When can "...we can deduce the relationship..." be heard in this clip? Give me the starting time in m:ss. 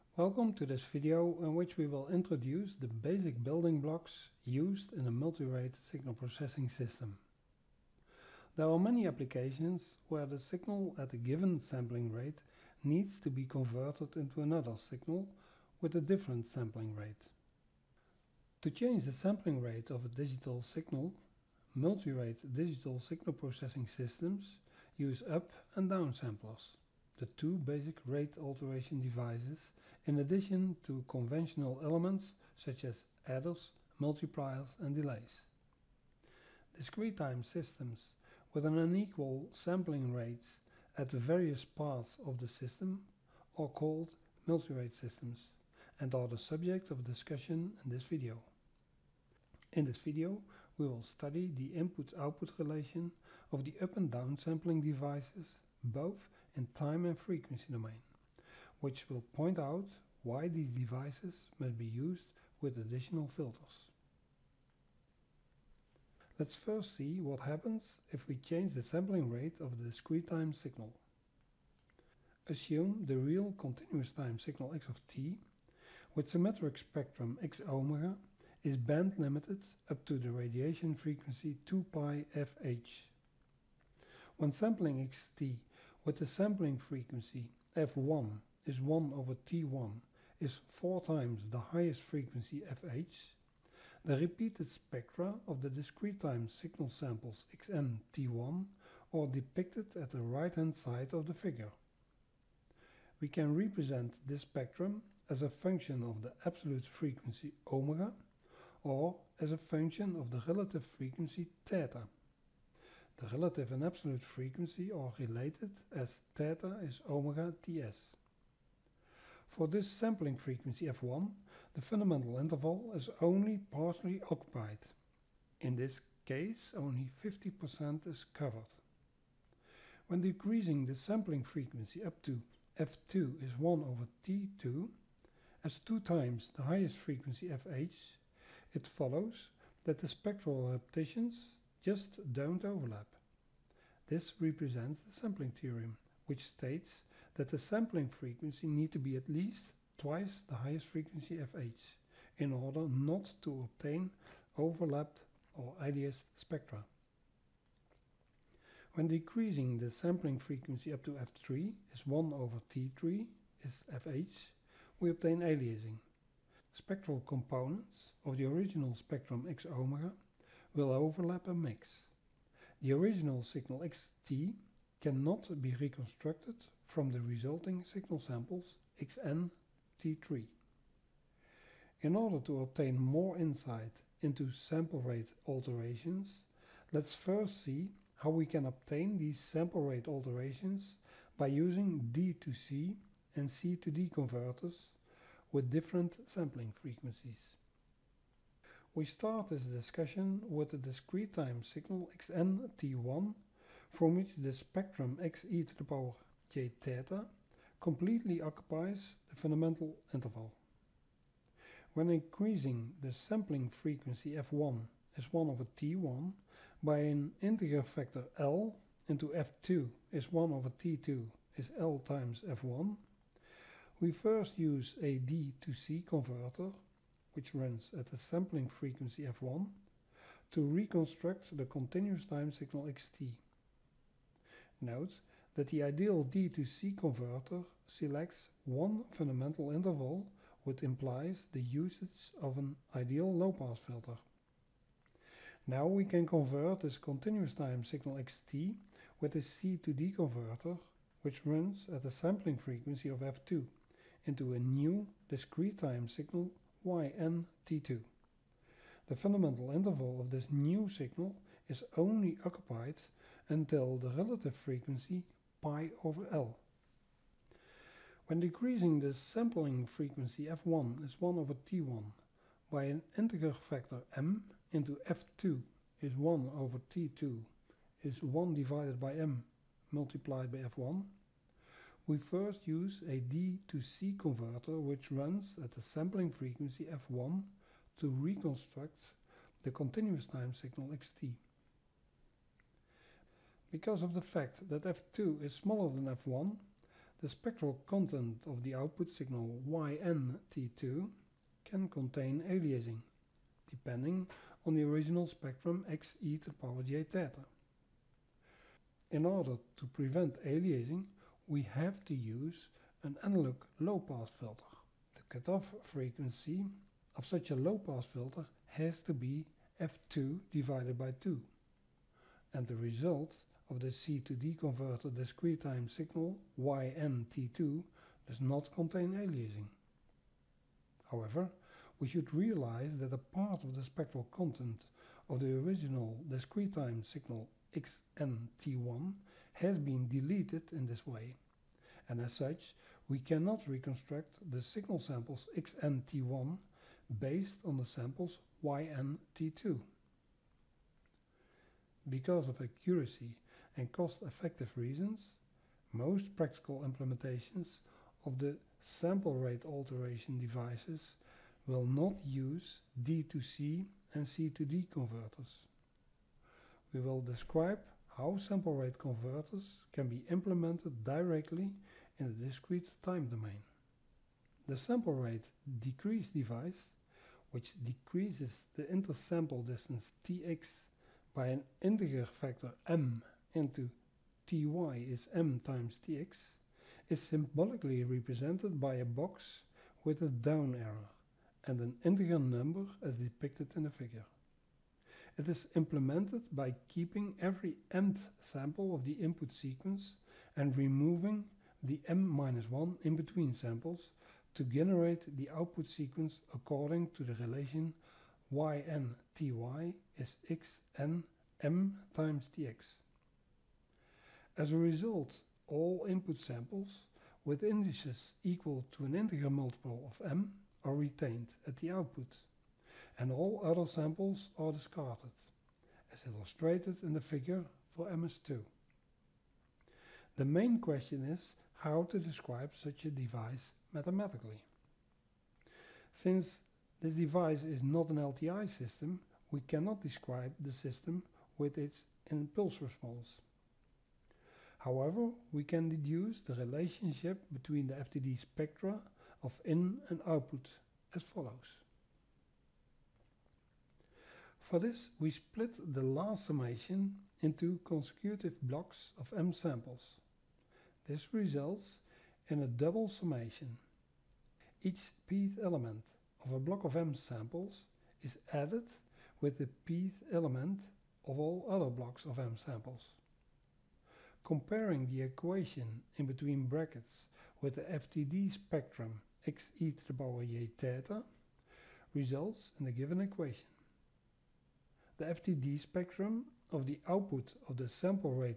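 7:25.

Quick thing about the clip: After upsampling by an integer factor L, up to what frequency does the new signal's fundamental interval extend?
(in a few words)
pi over L.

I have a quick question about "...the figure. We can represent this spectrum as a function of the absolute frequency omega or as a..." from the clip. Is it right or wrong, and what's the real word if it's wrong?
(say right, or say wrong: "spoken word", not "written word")
right.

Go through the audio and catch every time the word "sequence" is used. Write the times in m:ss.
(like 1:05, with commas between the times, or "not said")
6:39, 6:45.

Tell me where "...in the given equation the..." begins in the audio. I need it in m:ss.
8:02.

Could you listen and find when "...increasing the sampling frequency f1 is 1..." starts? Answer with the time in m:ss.
3:32.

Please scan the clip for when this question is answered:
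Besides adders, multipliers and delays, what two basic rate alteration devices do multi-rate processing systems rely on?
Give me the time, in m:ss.
0:25.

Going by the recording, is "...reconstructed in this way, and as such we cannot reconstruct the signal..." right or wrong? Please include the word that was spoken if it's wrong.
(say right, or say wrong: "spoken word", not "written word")
wrong: "deleted", not "reconstructed".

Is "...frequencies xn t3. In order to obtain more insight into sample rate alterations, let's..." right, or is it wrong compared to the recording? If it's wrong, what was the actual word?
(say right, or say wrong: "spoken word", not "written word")
wrong: "samples", not "frequencies".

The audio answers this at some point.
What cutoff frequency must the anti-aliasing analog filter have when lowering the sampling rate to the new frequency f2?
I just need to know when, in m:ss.
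5:19.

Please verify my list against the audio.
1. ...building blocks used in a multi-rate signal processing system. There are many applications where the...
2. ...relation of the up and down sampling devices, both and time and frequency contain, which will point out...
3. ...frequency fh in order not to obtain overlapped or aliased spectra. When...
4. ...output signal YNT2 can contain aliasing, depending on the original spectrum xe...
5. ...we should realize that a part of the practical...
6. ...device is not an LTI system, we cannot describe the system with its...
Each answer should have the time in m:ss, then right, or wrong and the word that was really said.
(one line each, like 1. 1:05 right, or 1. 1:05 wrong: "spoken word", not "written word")
1. 0:03 right
2. 0:52 wrong: "domain", not "contain"
3. 2:30 right
4. 4:58 right
5. 5:31 wrong: "spectral", not "practical"
6. 7:17 right.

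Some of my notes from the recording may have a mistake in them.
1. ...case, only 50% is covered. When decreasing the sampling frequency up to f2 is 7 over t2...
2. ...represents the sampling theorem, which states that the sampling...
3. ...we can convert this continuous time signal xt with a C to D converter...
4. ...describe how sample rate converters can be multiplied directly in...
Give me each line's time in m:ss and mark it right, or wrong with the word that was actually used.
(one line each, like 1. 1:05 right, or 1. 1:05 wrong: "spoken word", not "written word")
1. 2:06 wrong: "1", not "7"
2. 2:24 right
3. 4:05 right
4. 6:07 wrong: "implemented", not "multiplied".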